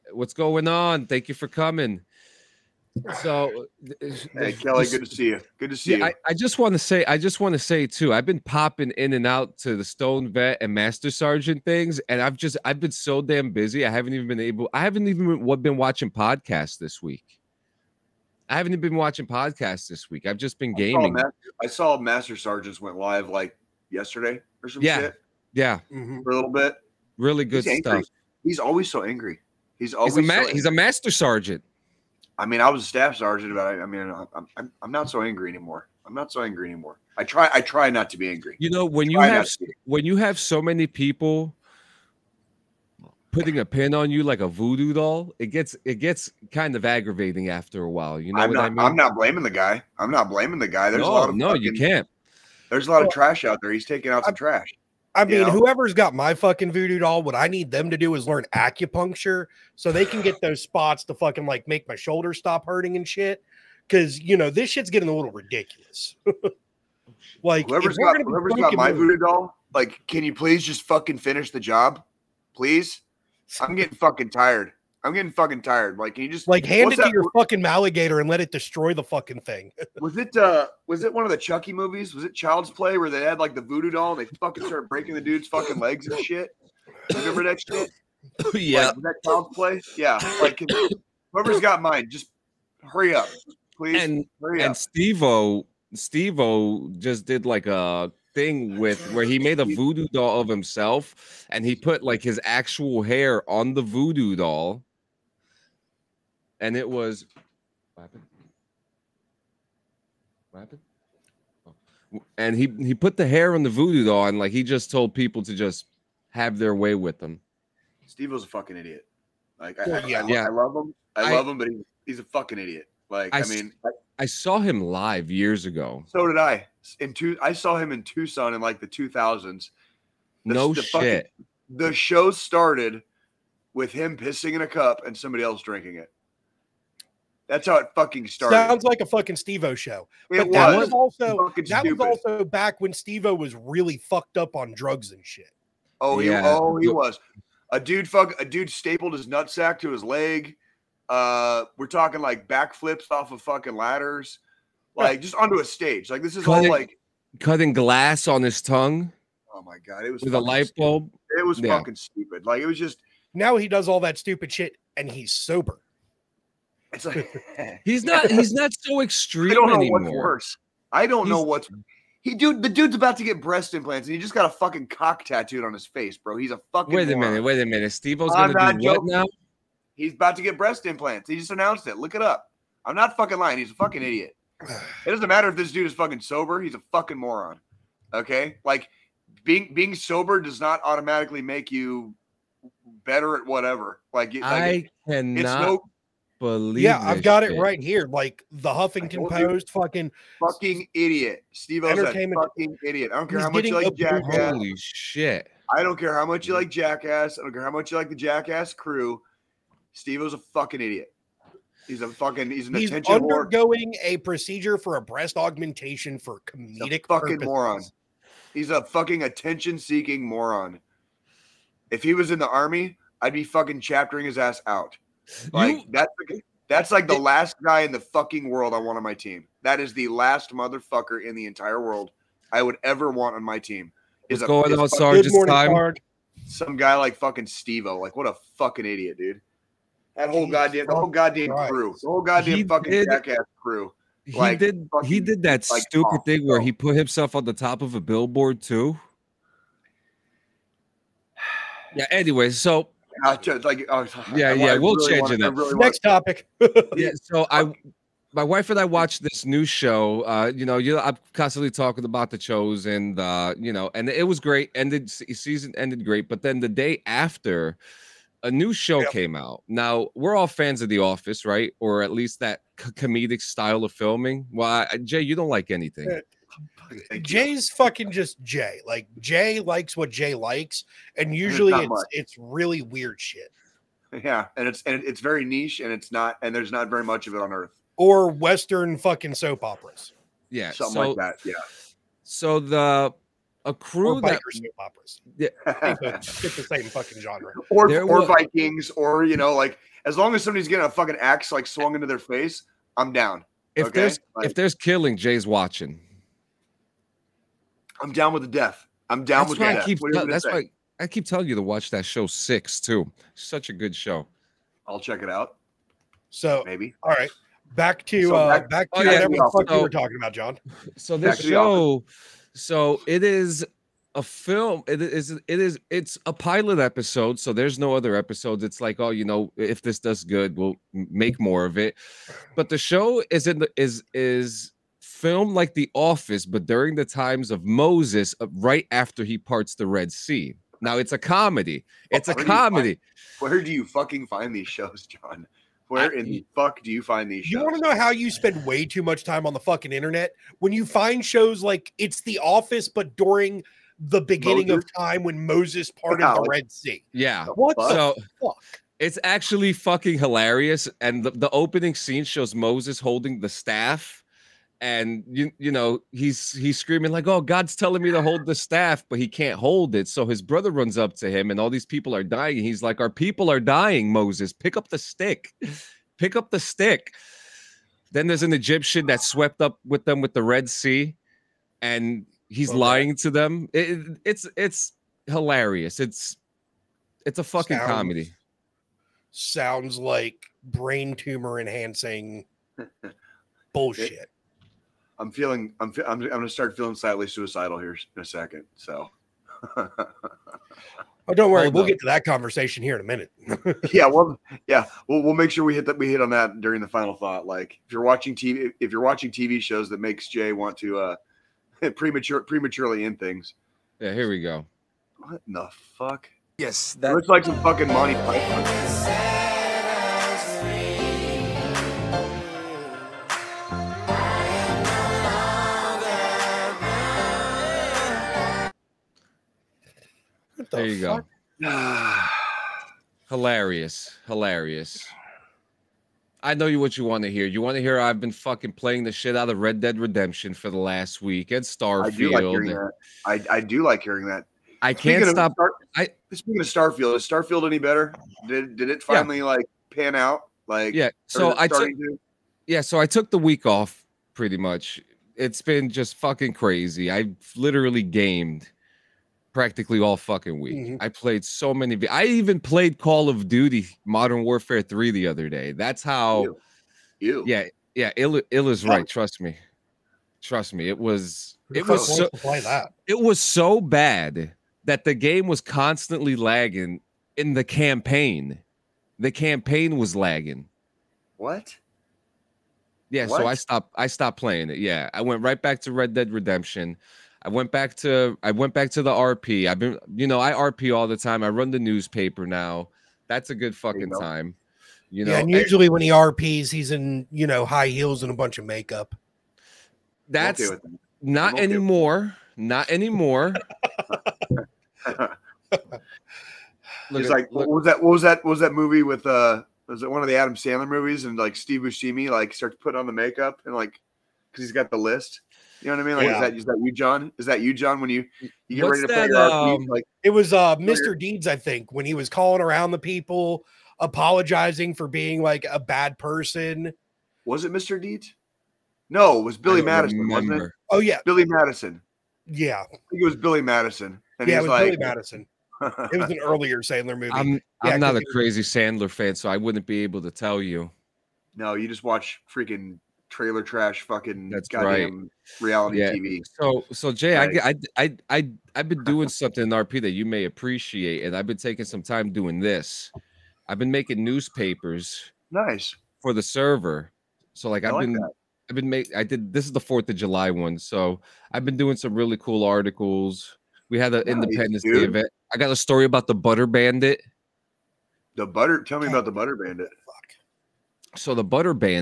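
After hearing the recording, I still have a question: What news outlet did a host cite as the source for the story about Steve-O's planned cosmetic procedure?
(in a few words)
Huffington Post.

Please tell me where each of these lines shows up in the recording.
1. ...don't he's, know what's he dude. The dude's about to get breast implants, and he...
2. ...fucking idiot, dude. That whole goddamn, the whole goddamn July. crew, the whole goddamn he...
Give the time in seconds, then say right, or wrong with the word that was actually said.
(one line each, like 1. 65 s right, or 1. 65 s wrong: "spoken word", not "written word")
1. 171 s right
2. 238 s wrong: "Christ", not "July".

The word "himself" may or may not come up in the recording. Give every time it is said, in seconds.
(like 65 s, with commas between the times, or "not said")
100 s, 246 s.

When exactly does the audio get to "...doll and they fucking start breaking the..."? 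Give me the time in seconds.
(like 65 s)
83 s.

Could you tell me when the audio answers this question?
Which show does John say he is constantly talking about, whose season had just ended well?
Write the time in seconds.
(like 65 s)
262 s.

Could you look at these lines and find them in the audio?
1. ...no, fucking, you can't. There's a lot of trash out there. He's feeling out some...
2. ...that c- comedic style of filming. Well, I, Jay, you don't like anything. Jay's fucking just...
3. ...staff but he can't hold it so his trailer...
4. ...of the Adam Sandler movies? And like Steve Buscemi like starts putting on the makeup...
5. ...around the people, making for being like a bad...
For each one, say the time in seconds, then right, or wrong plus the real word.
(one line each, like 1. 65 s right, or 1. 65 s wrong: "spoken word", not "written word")
1. 51 s wrong: "taking", not "feeling"
2. 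272 s right
3. 368 s wrong: "brother", not "trailer"
4. 510 s right
5. 522 s wrong: "apologizing", not "making".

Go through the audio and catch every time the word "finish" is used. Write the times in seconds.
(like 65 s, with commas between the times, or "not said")
71 s.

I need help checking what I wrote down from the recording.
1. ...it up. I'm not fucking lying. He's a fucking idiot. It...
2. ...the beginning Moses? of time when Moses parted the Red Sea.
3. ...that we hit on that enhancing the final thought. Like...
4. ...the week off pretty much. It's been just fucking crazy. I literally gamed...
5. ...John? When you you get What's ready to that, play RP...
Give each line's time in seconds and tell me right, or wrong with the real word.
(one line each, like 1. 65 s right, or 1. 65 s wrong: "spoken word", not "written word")
1. 182 s right
2. 353 s right
3. 405 s wrong: "during", not "enhancing"
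4. 453 s right
5. 517 s right.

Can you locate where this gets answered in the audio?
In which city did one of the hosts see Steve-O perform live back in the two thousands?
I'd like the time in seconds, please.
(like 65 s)
128 s.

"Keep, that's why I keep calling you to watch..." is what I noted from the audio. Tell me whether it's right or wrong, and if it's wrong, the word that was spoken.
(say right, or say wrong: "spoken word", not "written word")
wrong: "telling", not "calling".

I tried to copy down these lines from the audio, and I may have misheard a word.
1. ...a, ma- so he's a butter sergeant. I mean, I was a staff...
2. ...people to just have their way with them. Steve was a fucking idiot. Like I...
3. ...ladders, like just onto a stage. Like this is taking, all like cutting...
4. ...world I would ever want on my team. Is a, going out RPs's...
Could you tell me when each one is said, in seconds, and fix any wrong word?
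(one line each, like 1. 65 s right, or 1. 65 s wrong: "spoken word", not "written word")
1. 30 s wrong: "master", not "butter"
2. 115 s right
3. 153 s wrong: "cutting", not "taking"
4. 231 s wrong: "Sarge", not "RPs".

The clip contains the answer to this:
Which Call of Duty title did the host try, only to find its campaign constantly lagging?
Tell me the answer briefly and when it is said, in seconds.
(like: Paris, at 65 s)
Modern Warfare 3, at 464 s.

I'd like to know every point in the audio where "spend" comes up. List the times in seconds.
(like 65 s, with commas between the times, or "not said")
348 s.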